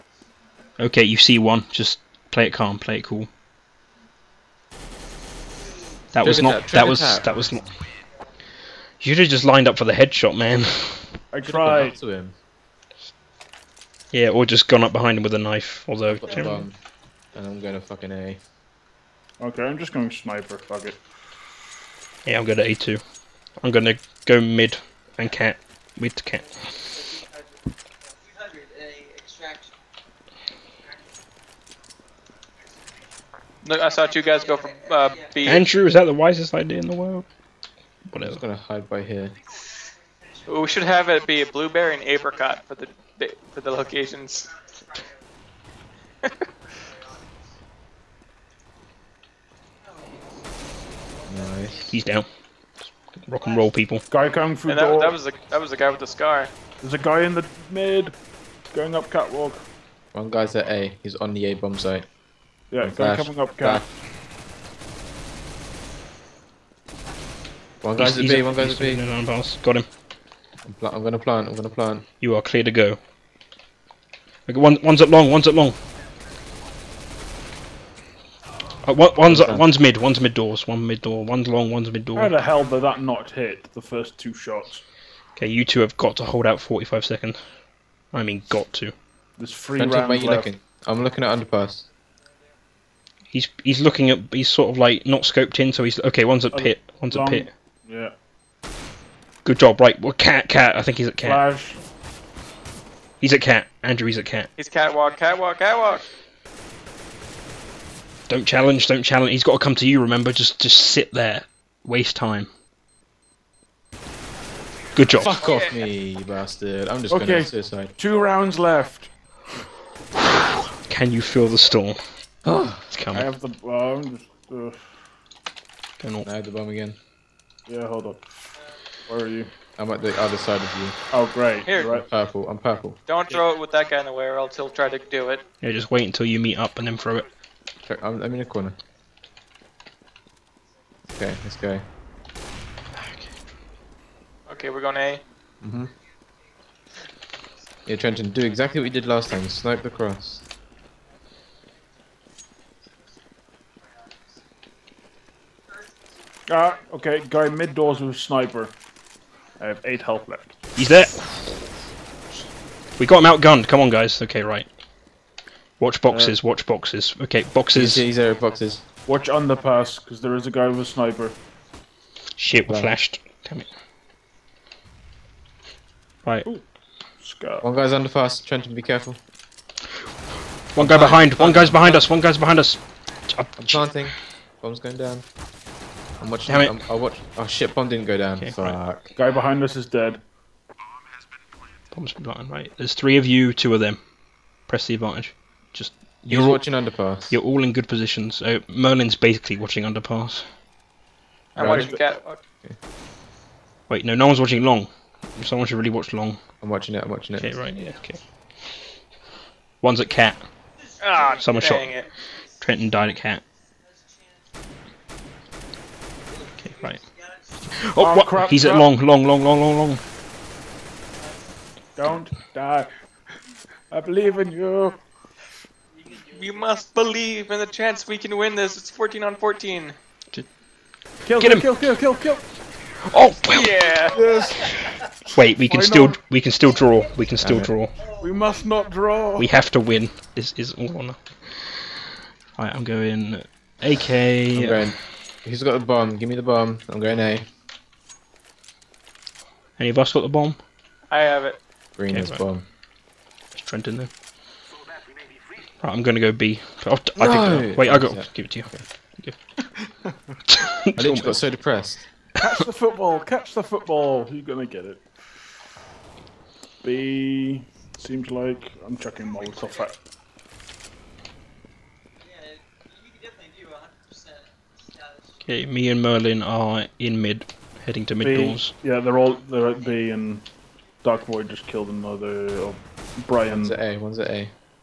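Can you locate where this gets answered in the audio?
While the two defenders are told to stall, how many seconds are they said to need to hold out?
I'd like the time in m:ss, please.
1:26.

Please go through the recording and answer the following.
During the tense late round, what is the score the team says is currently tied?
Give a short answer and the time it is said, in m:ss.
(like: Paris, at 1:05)
14 on 14, at 3:48.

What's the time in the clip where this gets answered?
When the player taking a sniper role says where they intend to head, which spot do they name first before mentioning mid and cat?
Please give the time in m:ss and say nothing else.
0:22.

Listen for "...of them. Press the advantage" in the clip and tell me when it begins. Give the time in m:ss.
3:13.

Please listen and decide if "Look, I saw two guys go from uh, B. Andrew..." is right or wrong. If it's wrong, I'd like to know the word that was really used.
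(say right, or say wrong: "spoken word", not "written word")
right.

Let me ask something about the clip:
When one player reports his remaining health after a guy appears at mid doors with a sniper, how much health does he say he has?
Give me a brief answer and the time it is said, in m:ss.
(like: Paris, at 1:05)
8, at 2:39.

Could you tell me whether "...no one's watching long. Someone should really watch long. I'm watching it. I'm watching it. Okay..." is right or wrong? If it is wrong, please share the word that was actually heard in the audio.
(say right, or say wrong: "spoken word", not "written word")
right.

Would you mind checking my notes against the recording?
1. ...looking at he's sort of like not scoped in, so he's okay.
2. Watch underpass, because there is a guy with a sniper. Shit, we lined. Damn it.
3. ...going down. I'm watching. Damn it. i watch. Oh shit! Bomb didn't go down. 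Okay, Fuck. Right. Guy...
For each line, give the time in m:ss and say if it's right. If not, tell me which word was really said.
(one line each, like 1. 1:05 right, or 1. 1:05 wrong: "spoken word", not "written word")
1. 1:33 right
2. 2:49 wrong: "flashed", not "lined"
3. 3:04 right.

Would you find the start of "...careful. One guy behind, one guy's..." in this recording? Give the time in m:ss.
2:58.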